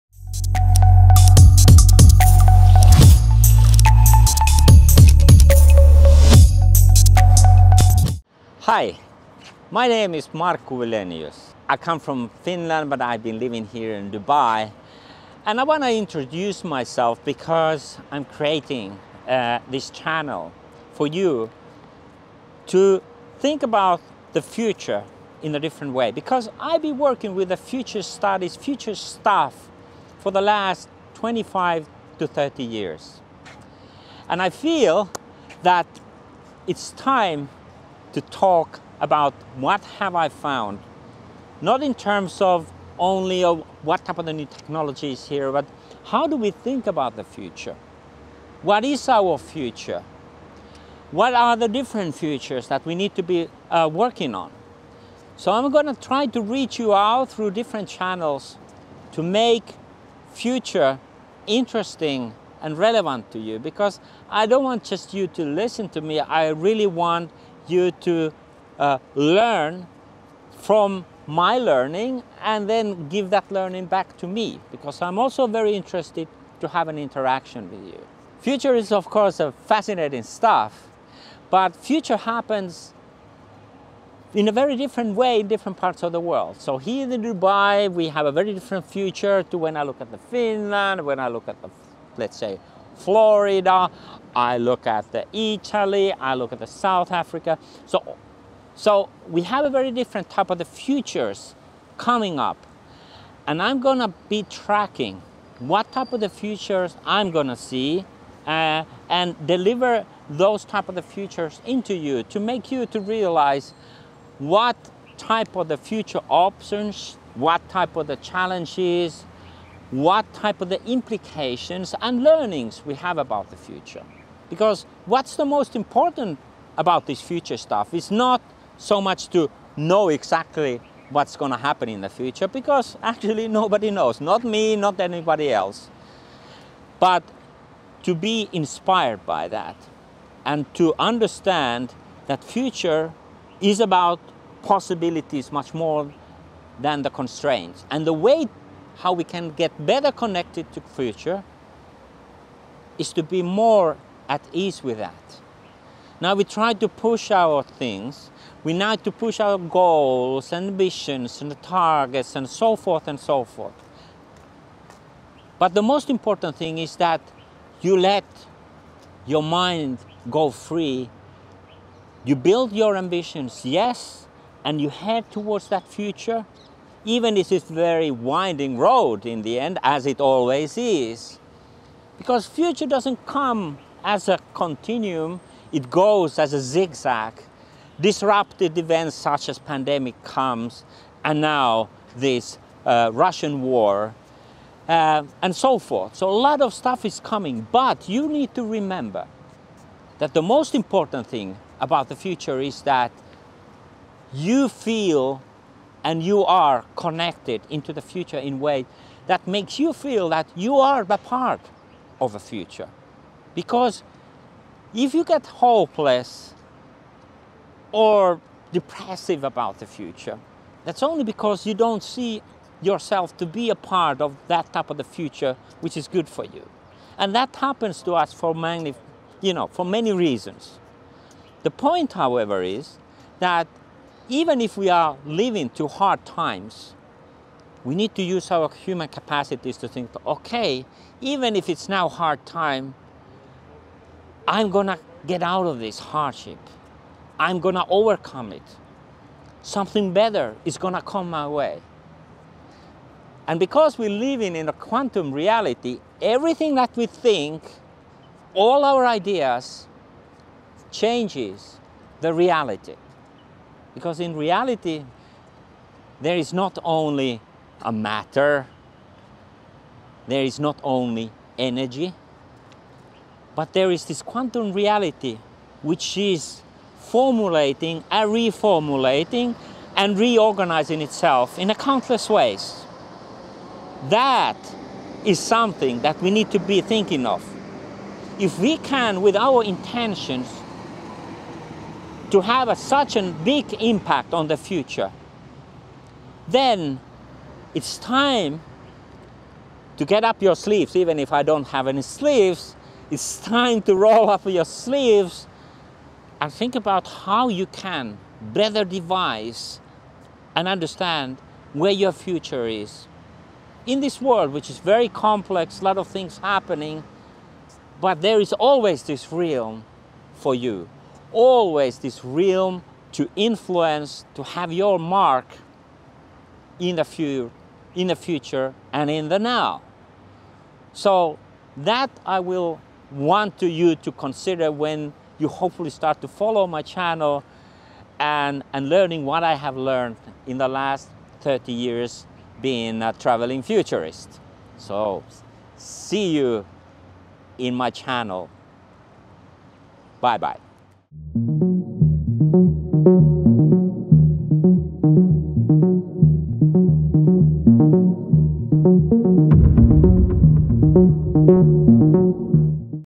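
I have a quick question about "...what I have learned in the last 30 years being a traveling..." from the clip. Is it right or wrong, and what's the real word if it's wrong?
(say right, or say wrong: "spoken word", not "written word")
right.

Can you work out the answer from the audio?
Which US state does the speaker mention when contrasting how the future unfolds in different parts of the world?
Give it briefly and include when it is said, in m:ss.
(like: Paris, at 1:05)
Florida, at 1:32.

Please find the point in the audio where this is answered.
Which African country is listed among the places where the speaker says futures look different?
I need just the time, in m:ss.
1:36.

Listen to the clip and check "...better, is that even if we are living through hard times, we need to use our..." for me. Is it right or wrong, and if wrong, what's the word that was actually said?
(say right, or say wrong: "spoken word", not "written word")
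wrong: "however", not "better".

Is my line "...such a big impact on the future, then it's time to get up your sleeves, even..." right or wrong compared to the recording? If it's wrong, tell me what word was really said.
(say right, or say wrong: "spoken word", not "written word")
right.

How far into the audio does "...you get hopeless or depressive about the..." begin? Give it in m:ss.
3:35.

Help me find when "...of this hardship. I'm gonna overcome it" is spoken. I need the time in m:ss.
4:05.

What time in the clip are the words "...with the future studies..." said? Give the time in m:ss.
0:27.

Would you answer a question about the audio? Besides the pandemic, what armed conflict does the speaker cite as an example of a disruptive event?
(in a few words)
Russian war.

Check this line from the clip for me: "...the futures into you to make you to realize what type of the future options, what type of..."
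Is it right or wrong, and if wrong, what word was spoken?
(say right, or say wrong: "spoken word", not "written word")
right.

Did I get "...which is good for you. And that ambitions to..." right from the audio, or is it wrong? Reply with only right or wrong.
wrong.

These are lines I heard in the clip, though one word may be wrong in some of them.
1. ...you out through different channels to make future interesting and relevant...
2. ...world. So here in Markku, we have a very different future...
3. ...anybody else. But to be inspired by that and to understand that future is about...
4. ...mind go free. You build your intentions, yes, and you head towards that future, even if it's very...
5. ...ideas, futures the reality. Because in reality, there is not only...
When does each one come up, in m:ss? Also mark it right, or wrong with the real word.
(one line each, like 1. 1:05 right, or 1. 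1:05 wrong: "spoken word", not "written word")
1. 0:56 right
2. 1:26 wrong: "Dubai", not "Markku"
3. 2:14 right
4. 2:49 wrong: "ambitions", not "intentions"
5. 4:19 wrong: "changes", not "futures".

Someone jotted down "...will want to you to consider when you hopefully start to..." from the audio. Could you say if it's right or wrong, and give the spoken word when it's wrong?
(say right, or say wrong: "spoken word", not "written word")
right.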